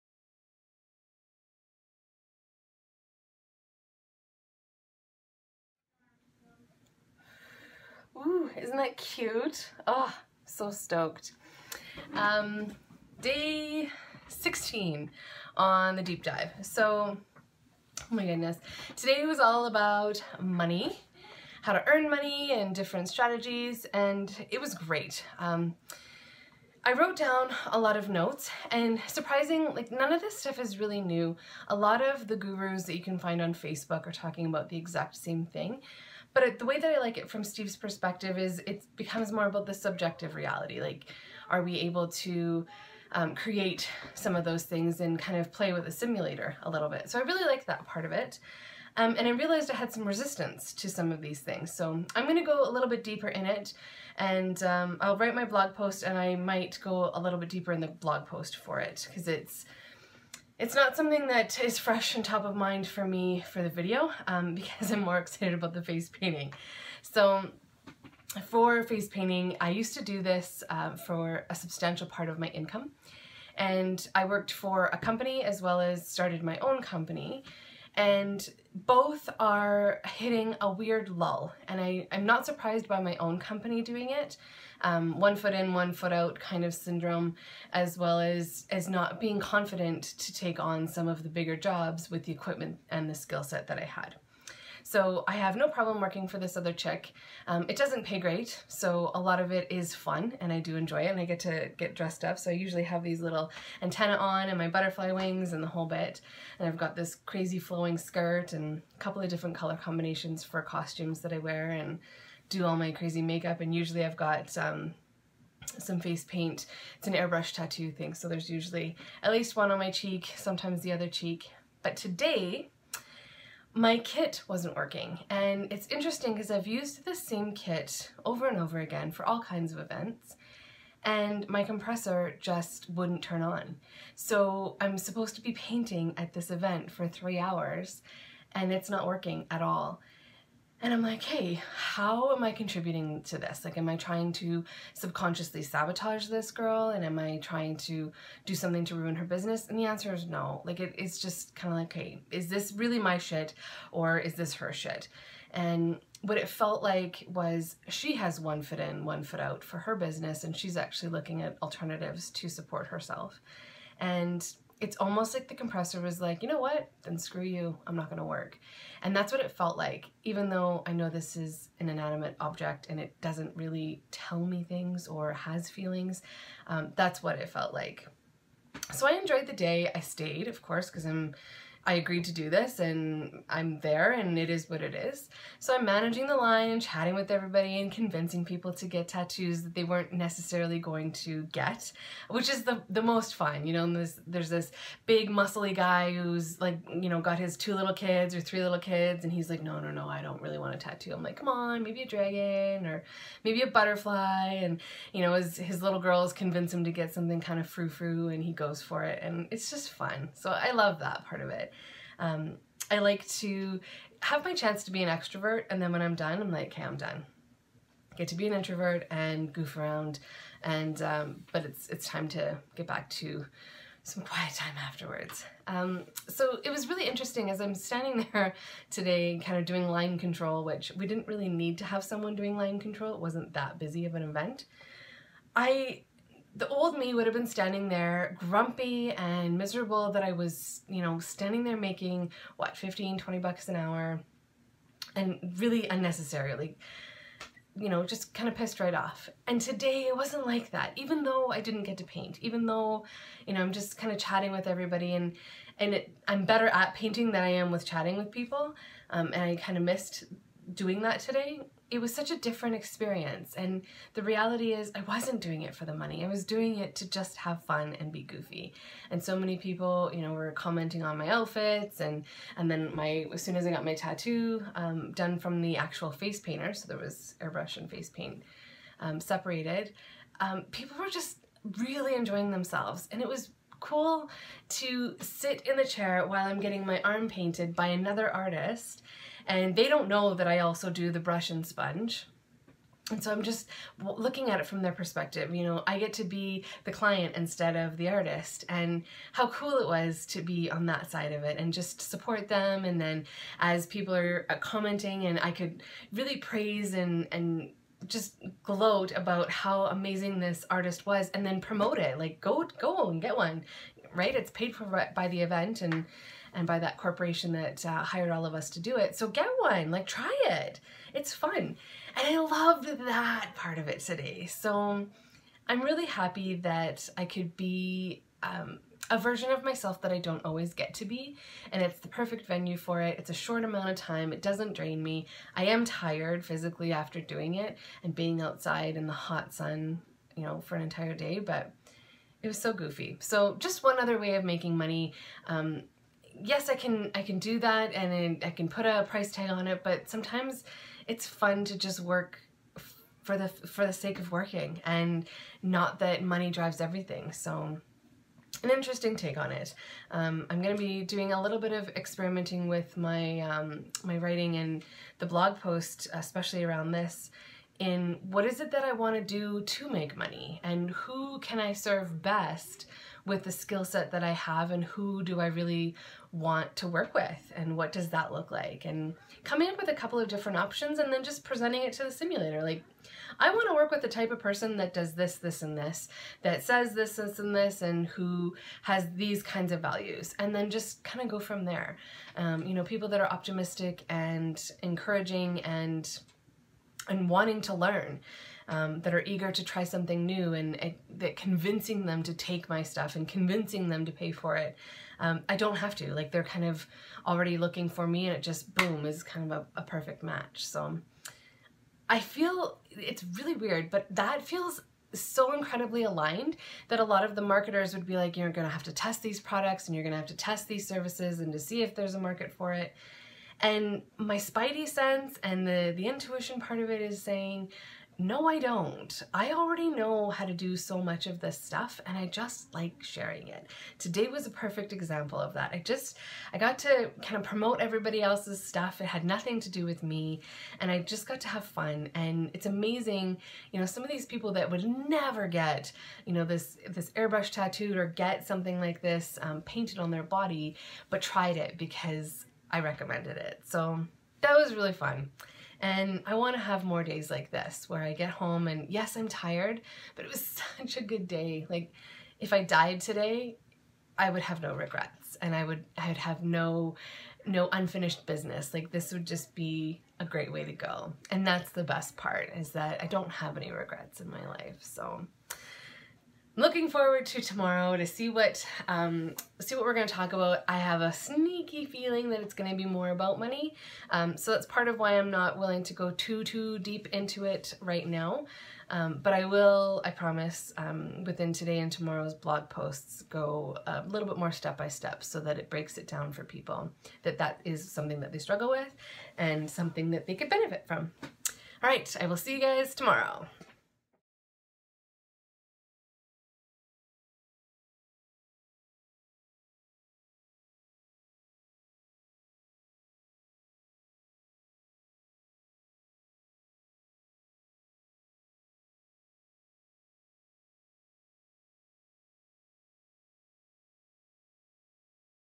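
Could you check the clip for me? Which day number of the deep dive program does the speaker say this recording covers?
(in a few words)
16.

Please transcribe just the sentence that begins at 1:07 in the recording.
So for face painting, I used to do this uh, for a substantial part of my income.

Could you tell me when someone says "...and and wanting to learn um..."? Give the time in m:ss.
6:35.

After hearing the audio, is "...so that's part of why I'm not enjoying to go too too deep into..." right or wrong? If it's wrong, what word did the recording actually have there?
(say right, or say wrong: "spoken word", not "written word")
wrong: "willing", not "enjoying".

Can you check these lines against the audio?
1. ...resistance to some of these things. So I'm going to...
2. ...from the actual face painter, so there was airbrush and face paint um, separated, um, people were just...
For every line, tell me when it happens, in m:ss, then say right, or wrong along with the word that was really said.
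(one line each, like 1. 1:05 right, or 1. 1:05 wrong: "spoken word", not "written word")
1. 0:50 right
2. 4:35 right.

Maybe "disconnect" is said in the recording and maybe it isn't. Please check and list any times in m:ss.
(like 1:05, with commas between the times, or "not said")
not said.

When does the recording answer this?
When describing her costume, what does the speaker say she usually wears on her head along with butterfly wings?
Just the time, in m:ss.
1:43.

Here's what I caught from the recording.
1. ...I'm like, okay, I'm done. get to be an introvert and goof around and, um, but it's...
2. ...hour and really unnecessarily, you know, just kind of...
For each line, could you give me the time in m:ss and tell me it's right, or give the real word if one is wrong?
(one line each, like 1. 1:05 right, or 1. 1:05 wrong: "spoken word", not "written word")
1. 3:36 right
2. 4:03 right.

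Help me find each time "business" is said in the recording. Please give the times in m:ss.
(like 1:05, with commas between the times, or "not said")
2:29, 2:39, 7:48.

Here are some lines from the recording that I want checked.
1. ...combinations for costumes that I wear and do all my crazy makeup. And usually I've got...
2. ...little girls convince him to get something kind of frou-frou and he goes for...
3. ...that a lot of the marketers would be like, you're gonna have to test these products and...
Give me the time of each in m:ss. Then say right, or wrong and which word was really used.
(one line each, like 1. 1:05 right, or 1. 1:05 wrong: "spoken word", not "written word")
1. 1:49 right
2. 3:25 right
3. 6:56 right.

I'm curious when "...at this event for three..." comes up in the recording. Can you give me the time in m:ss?
2:16.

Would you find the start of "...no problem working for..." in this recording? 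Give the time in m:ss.
1:35.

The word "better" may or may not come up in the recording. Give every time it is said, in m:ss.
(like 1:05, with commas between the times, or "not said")
4:16.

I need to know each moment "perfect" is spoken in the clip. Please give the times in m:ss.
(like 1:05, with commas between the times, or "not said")
5:32, 6:49, 7:14.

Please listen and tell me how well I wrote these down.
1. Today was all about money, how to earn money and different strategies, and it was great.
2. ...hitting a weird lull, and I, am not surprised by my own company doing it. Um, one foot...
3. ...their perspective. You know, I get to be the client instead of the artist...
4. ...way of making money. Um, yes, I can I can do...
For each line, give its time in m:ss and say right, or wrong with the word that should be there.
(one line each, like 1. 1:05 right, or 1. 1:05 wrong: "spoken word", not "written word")
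1. 0:18 right
2. 1:20 right
3. 4:54 right
4. 5:44 right.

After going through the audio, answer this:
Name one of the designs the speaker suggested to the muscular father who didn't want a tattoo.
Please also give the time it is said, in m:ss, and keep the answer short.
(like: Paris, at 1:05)
Dragon, at 3:22.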